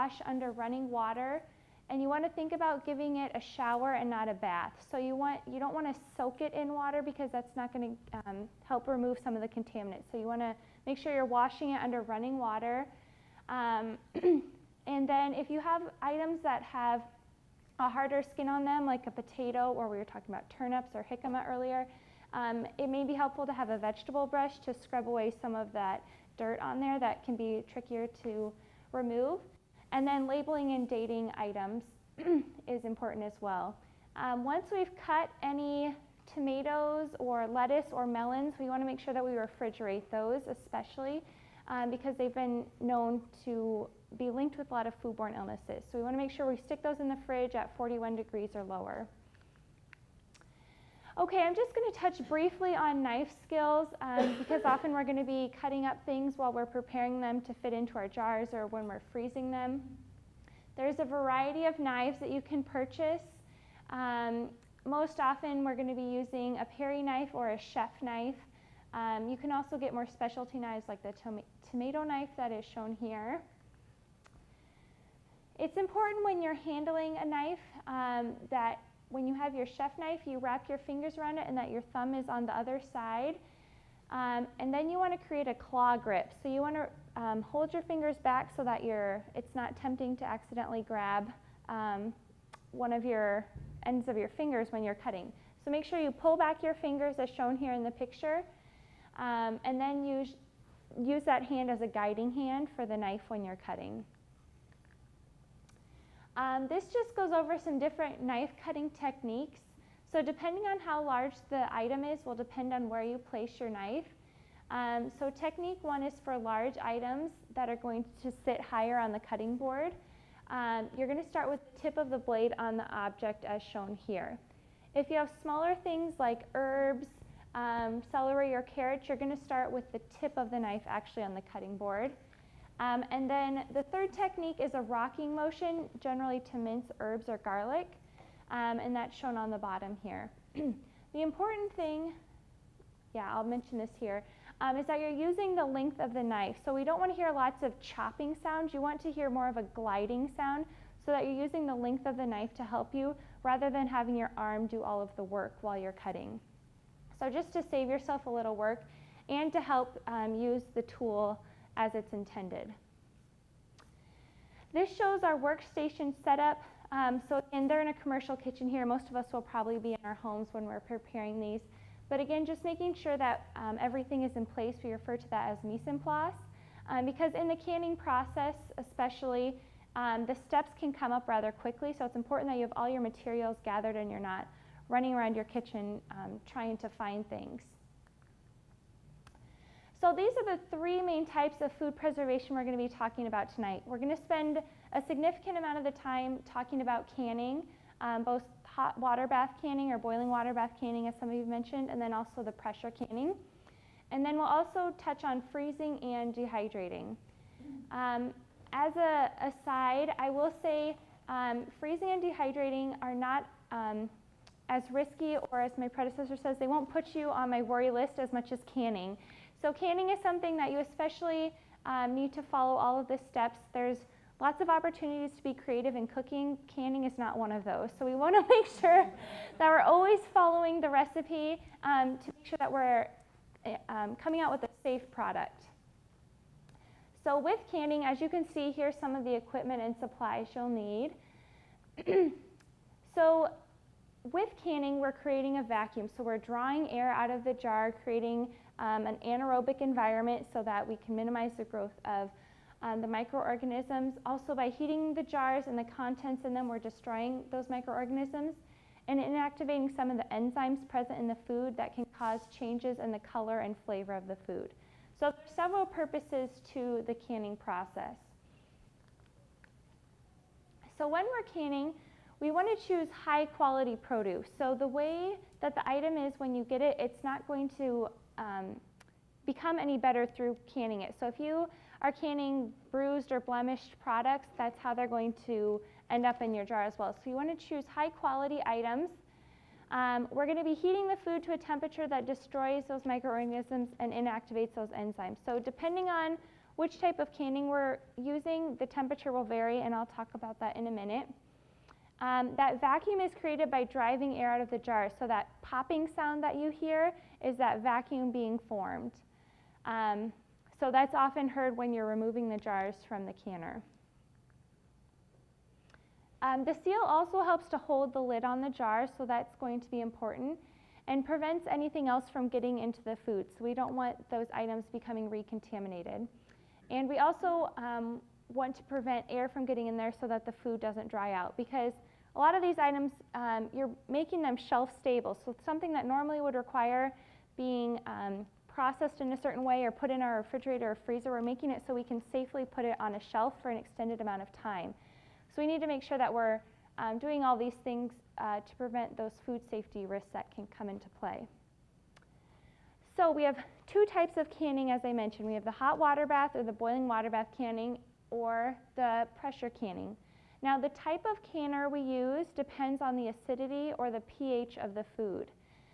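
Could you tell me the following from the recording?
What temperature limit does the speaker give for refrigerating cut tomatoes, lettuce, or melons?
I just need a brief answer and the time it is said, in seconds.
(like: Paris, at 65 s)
41 degrees, at 47 s.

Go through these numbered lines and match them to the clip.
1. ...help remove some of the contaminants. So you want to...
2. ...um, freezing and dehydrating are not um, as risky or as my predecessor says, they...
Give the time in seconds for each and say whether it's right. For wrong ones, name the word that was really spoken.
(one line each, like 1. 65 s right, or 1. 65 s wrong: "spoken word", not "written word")
1. 8 s right
2. 211 s right.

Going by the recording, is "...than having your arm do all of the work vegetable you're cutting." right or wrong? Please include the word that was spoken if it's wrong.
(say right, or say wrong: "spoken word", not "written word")
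wrong: "while", not "vegetable".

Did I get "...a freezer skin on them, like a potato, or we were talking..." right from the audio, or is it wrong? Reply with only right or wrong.
wrong.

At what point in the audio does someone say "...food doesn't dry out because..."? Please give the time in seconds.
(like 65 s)
330 s.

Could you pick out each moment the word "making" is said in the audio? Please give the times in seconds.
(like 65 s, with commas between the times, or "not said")
172 s, 334 s, 341 s.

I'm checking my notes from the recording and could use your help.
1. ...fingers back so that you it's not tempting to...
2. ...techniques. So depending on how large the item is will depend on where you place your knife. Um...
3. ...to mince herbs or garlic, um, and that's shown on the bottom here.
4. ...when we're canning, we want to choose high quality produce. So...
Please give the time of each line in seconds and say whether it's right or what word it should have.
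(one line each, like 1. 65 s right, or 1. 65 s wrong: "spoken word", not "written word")
1. 87 s right
2. 108 s right
3. 136 s right
4. 271 s right.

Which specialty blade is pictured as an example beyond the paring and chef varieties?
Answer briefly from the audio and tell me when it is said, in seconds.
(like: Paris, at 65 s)
tomato knife, at 71 s.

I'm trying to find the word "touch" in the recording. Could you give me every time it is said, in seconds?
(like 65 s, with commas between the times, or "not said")
51 s, 204 s.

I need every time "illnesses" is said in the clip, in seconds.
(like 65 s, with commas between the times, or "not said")
45 s.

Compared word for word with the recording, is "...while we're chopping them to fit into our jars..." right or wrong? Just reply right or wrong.
wrong.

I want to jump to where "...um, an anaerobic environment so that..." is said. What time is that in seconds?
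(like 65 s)
248 s.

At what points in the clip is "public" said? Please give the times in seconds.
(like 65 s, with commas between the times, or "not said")
not said.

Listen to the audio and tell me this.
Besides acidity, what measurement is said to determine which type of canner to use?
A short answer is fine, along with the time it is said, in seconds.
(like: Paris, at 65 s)
pH, at 364 s.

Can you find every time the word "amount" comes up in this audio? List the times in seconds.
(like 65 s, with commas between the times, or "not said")
195 s, 344 s.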